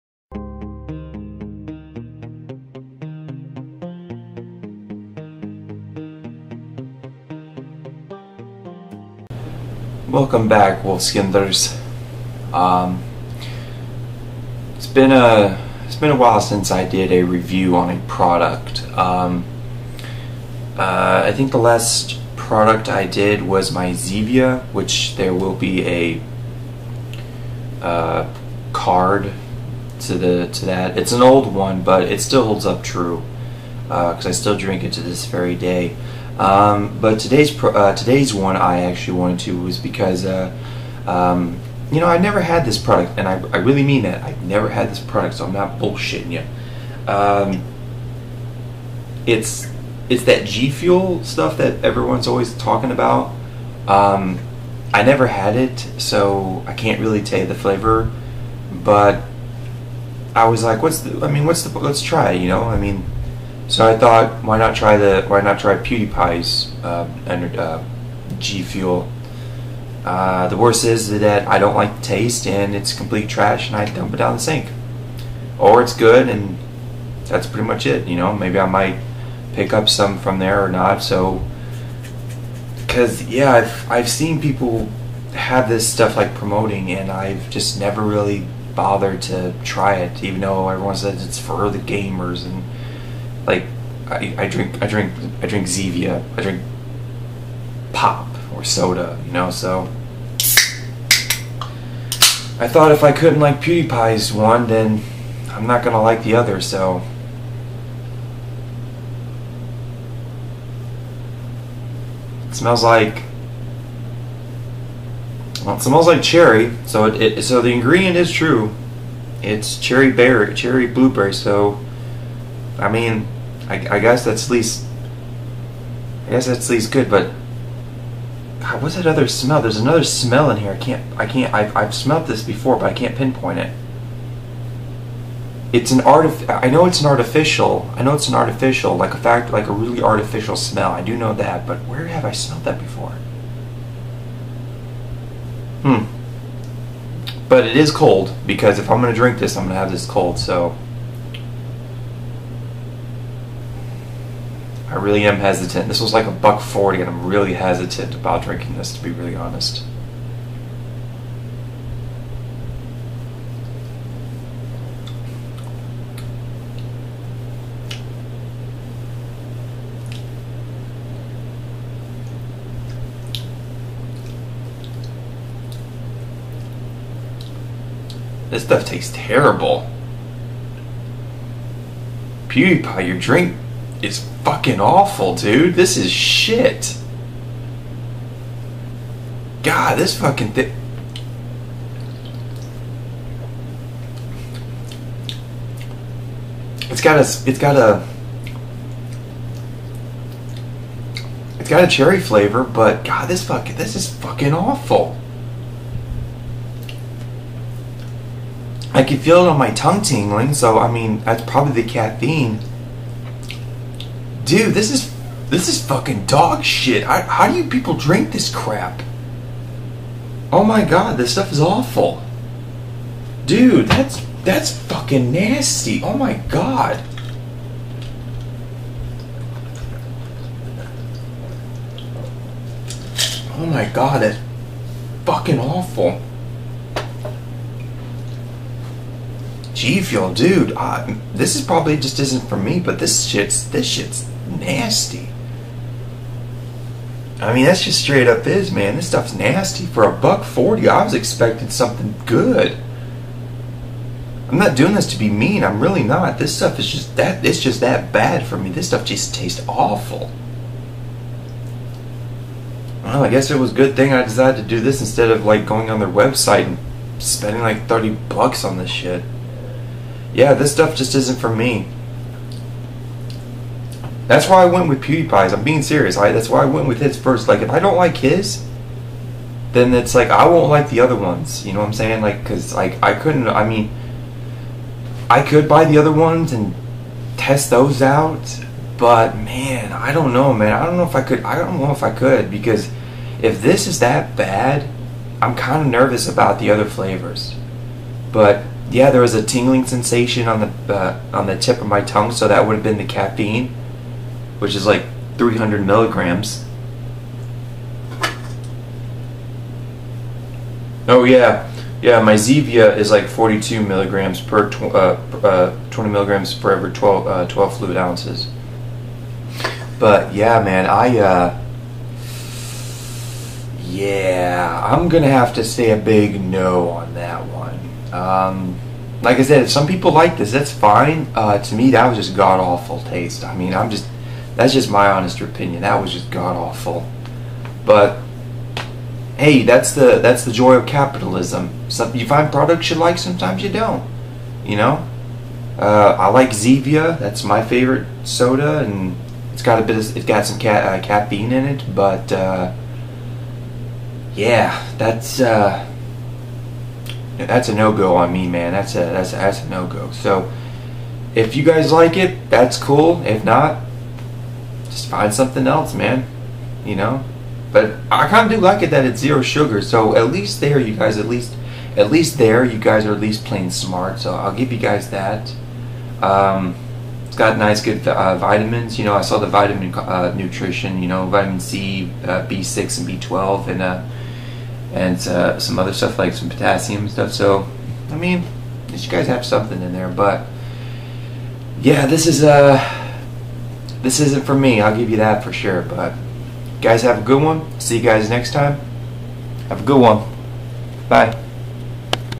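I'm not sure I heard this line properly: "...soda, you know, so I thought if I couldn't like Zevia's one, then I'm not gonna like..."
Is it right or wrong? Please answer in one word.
wrong.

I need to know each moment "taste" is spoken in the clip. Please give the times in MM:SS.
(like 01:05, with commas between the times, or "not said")
01:12, 02:58, 04:19, 05:33.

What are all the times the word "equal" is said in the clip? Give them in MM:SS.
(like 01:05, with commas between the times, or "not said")
not said.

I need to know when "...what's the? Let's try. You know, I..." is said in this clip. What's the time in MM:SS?
01:01.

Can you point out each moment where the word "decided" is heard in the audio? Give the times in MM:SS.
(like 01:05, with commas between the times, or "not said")
04:24.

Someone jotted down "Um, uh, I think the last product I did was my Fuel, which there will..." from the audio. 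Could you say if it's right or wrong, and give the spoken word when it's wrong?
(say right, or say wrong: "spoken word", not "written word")
wrong: "Zevia", not "Fuel".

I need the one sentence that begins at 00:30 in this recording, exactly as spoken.
It's an old one, but it still holds up true because uh, I still drink it to this very day.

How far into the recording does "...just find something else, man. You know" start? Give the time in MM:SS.
06:04.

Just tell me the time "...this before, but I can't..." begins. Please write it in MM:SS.
02:12.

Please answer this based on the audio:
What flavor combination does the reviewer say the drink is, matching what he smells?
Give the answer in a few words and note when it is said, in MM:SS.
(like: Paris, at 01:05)
Cherry blueberry, at 02:00.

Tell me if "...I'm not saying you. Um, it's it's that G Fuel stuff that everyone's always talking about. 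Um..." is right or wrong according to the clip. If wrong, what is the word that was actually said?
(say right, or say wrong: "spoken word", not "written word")
wrong: "bullshitting", not "saying".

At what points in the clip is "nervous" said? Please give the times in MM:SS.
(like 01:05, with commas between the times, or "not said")
04:55.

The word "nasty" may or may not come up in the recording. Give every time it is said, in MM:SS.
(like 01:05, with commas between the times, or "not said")
03:45, 04:04, 04:09.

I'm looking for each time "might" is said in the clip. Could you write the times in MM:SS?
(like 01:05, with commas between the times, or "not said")
01:18.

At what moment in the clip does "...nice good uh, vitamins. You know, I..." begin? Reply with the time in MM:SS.
06:17.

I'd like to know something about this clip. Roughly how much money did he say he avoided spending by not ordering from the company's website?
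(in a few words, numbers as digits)
$30.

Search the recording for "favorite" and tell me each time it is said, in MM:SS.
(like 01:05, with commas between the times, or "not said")
05:47.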